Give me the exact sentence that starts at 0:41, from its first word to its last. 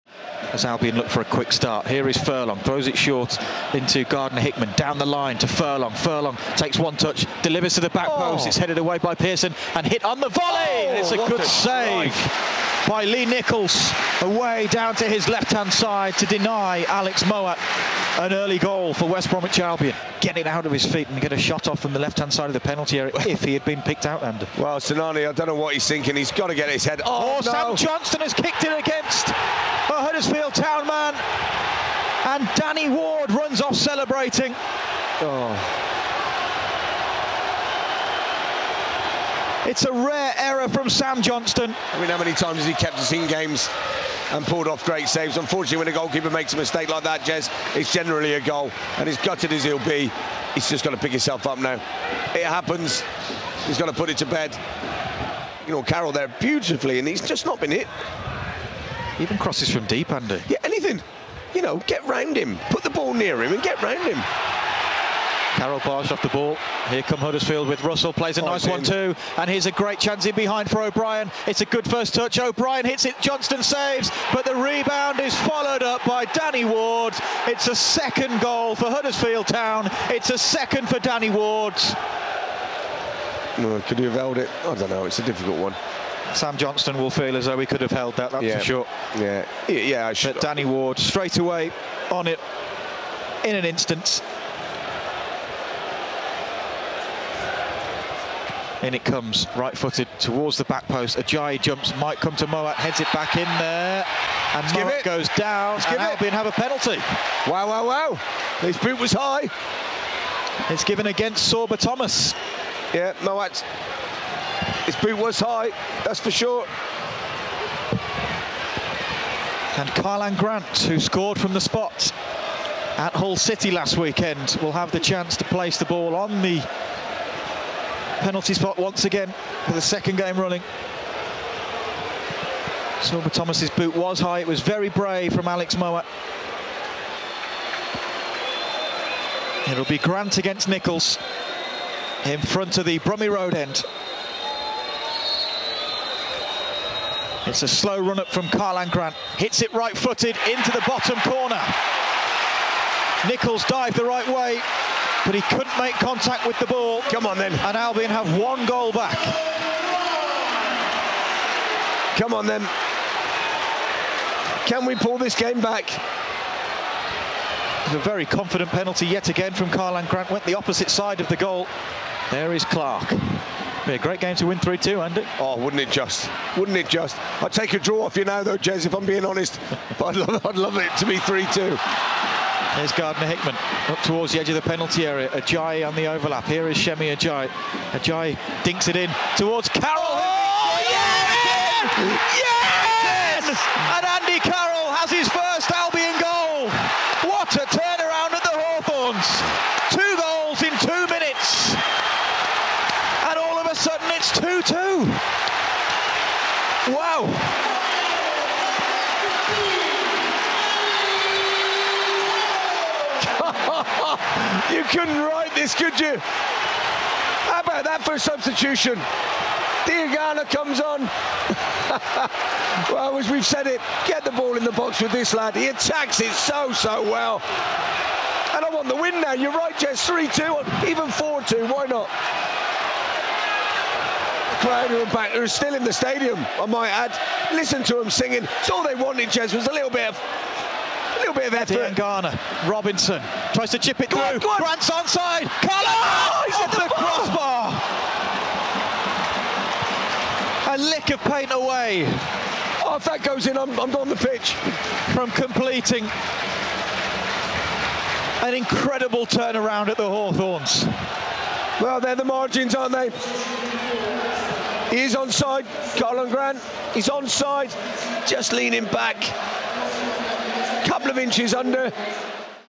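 I mean, how many times has he kept us in games and pulled off great saves?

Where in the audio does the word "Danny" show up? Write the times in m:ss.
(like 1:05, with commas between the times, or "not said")
0:32, 1:16, 1:20, 1:30.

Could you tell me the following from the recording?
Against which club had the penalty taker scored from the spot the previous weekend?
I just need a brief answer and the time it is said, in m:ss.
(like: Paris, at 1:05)
Hull City, at 2:03.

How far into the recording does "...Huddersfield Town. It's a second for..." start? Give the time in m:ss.
1:18.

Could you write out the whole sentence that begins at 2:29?
Hits it right footed into the bottom corner.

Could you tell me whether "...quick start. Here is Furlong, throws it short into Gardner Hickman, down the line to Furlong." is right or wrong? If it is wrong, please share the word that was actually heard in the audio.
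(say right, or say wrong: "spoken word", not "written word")
right.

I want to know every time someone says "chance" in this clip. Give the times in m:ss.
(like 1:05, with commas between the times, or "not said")
1:09, 2:04.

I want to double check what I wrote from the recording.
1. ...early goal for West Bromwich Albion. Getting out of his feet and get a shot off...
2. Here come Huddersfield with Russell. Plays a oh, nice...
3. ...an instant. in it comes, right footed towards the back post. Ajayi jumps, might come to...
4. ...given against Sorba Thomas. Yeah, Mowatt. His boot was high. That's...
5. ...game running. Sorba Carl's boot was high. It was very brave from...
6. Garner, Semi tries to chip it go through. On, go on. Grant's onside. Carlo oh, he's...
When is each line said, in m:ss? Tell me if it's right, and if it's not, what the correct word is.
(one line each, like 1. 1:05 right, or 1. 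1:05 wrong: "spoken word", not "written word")
1. 0:18 right
2. 1:06 right
3. 1:33 right
4. 1:50 right
5. 2:10 wrong: "Thomas", not "Carl"
6. 4:01 wrong: "Robinson", not "Semi".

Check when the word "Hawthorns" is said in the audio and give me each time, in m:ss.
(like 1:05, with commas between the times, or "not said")
3:18, 4:20.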